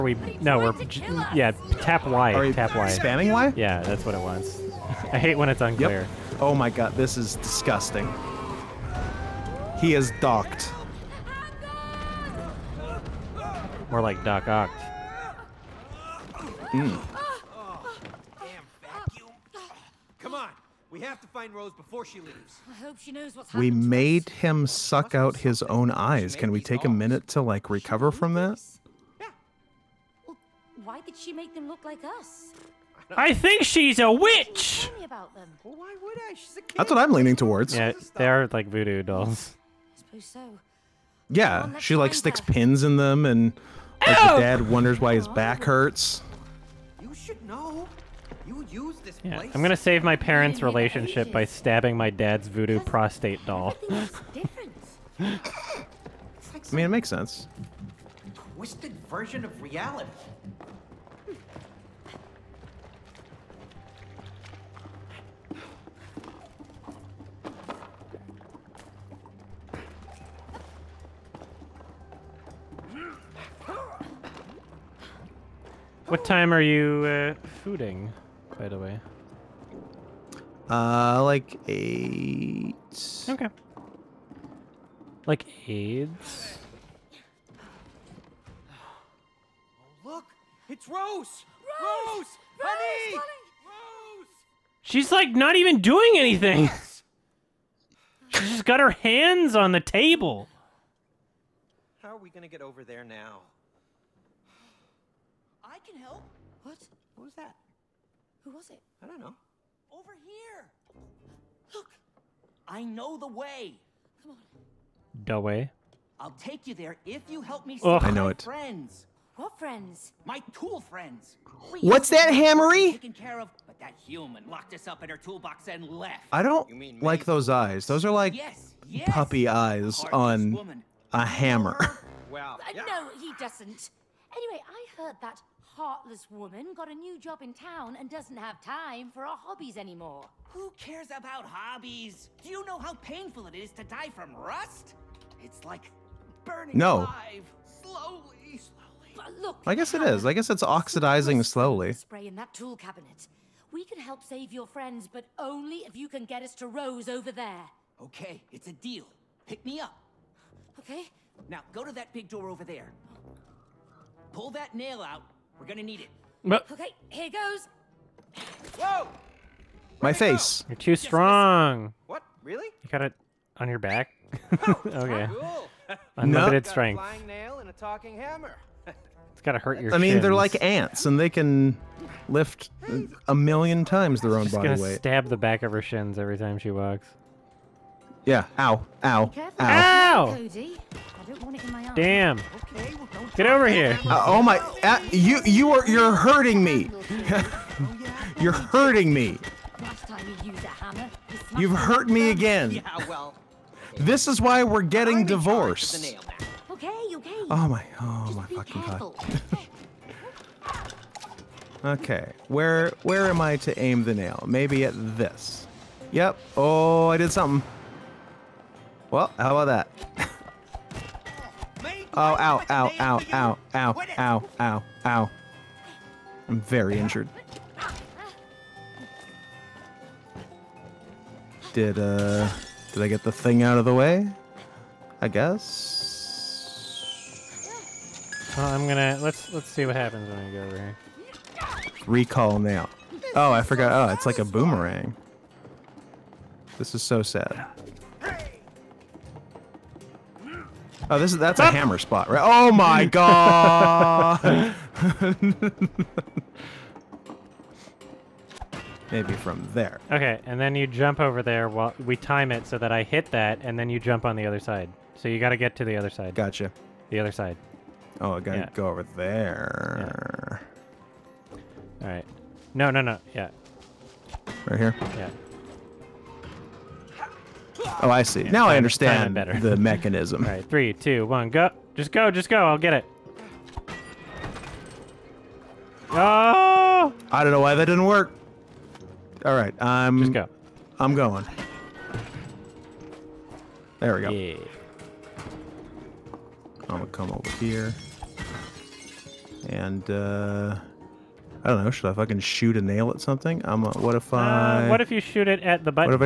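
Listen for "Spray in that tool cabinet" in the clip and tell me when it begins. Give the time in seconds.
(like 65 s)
151 s.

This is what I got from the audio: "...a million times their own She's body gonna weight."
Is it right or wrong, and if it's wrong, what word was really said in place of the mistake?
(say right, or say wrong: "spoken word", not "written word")
right.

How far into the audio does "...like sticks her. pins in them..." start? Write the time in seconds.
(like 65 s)
41 s.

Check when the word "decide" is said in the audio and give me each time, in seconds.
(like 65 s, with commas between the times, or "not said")
not said.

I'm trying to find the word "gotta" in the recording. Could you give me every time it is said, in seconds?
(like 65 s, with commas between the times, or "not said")
179 s, 268 s.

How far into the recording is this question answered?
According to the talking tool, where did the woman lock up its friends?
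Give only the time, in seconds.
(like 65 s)
125 s.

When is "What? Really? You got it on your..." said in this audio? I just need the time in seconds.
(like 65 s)
172 s.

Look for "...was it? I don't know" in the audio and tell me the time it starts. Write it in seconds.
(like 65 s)
108 s.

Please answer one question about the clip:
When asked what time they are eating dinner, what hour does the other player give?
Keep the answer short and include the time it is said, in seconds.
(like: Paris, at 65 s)
8, at 81 s.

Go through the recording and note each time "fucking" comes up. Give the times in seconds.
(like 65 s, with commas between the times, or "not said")
208 s, 302 s.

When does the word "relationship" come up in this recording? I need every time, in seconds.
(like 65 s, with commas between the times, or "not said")
50 s.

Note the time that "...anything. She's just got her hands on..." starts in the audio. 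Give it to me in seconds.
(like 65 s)
96 s.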